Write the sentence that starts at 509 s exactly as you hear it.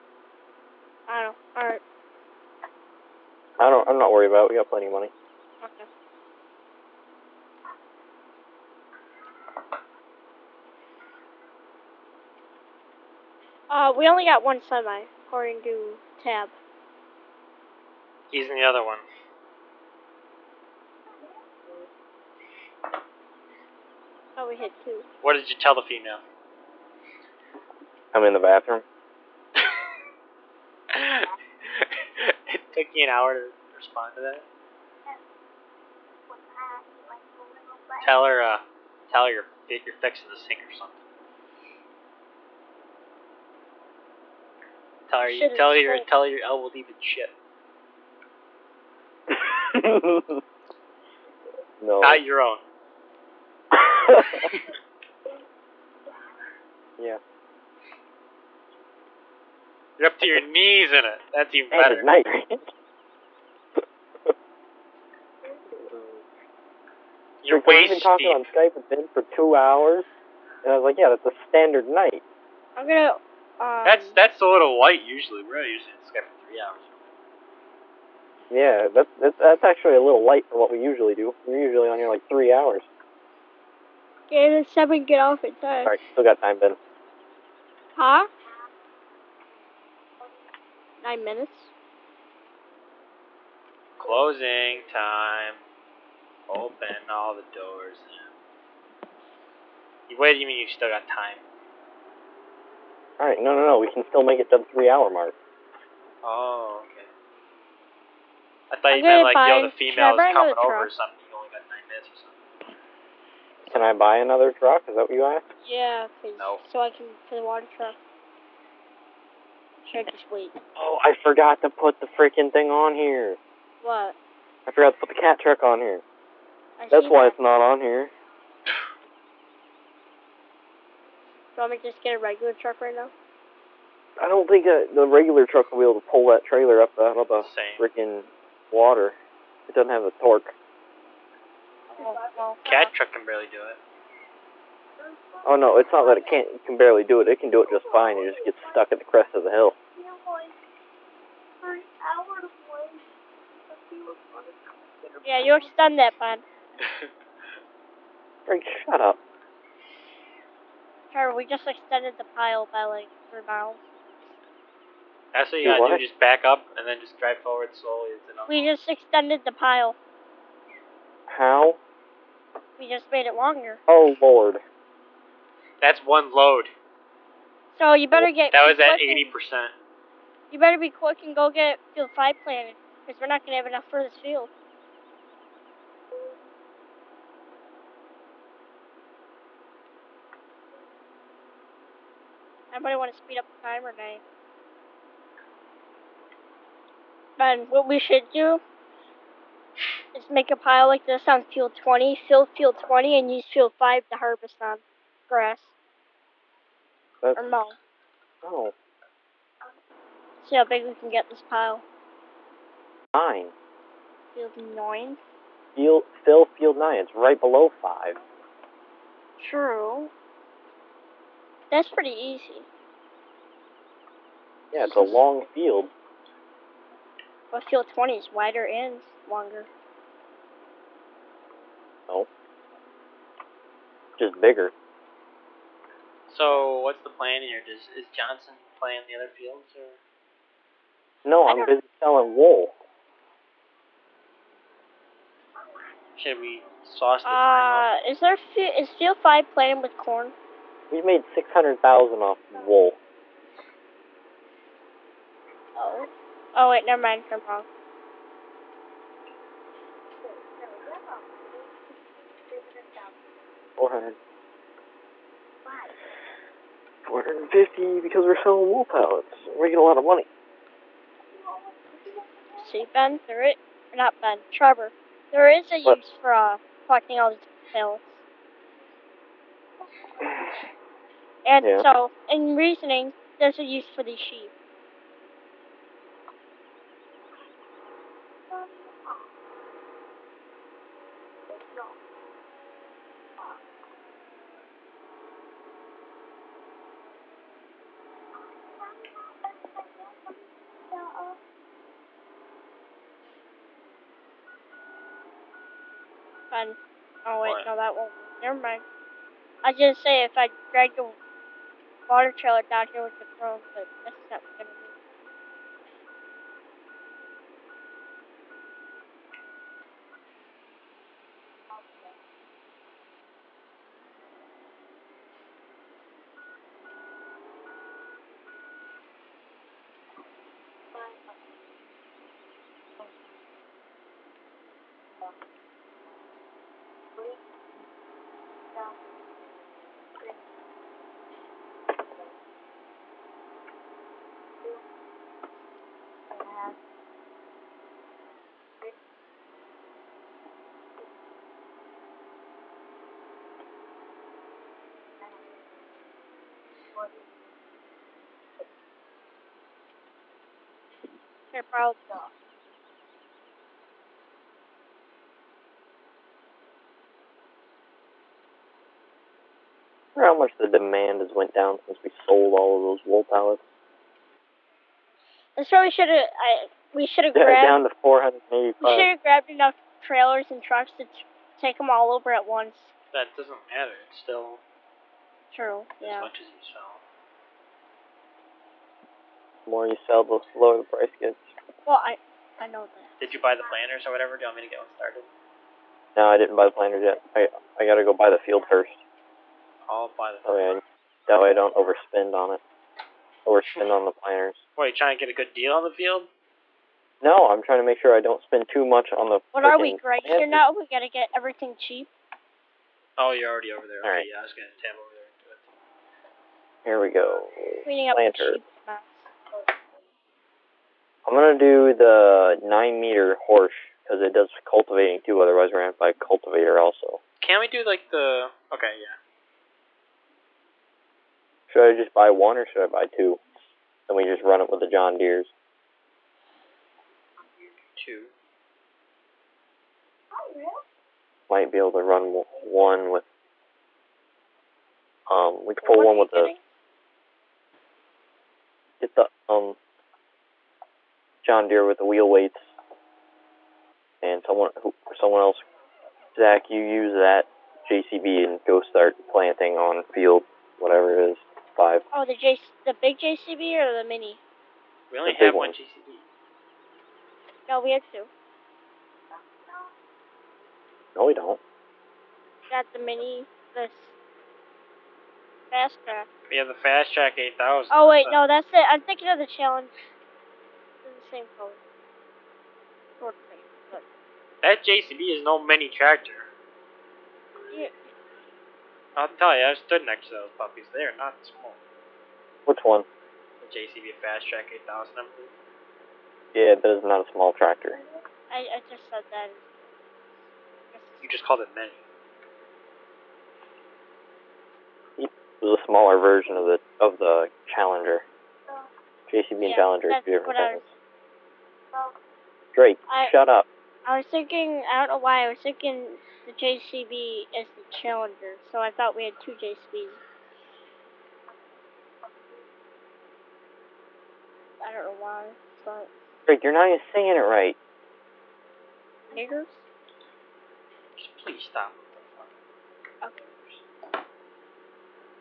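JCB yeah, and Challenger, two different things.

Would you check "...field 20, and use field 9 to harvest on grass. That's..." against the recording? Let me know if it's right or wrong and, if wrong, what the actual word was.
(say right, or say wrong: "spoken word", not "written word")
wrong: "5", not "9".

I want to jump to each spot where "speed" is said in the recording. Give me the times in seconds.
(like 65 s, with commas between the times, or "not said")
193 s.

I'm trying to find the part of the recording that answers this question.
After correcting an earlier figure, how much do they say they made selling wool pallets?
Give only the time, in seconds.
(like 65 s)
267 s.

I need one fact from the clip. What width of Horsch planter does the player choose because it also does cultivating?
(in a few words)
9 meter.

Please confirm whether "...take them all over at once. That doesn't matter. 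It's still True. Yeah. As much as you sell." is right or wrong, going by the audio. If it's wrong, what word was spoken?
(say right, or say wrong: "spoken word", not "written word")
right.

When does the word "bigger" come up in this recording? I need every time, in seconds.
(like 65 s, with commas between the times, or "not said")
234 s.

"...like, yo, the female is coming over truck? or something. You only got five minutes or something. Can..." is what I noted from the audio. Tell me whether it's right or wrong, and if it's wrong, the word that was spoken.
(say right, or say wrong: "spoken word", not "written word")
wrong: "nine", not "five".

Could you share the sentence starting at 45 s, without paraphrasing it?
Tell her, you, tell her, your, tell her your elbow in shit.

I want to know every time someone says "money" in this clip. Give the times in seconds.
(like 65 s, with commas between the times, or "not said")
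4 s, 270 s.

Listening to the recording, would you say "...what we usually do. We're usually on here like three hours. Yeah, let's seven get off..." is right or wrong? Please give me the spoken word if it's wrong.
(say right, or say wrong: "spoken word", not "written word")
right.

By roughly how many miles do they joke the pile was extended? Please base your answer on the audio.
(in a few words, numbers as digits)
3.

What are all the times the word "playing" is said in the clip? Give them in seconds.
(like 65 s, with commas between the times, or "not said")
238 s, 249 s.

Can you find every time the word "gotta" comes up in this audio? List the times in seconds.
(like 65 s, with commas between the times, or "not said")
165 s, 397 s, 410 s.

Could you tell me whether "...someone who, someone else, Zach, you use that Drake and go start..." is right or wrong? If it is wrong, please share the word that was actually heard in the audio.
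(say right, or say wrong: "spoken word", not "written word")
wrong: "JCB", not "Drake".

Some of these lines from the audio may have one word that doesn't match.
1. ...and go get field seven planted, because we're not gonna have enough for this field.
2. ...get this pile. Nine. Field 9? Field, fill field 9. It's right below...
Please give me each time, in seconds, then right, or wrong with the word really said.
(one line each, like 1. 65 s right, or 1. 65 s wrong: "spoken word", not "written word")
1. 181 s wrong: "five", not "seven"
2. 211 s right.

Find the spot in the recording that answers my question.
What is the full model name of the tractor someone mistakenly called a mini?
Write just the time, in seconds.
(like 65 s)
493 s.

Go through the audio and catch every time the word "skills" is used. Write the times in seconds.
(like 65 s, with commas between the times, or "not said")
not said.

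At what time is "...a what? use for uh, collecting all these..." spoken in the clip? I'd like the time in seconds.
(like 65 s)
275 s.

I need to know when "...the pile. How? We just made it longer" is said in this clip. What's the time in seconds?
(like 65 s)
169 s.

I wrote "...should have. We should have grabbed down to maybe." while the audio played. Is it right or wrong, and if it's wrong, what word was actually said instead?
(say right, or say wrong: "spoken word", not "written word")
right.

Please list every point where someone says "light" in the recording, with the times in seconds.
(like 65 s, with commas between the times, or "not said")
74 s, 80 s.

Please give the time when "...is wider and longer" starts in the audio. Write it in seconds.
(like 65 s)
228 s.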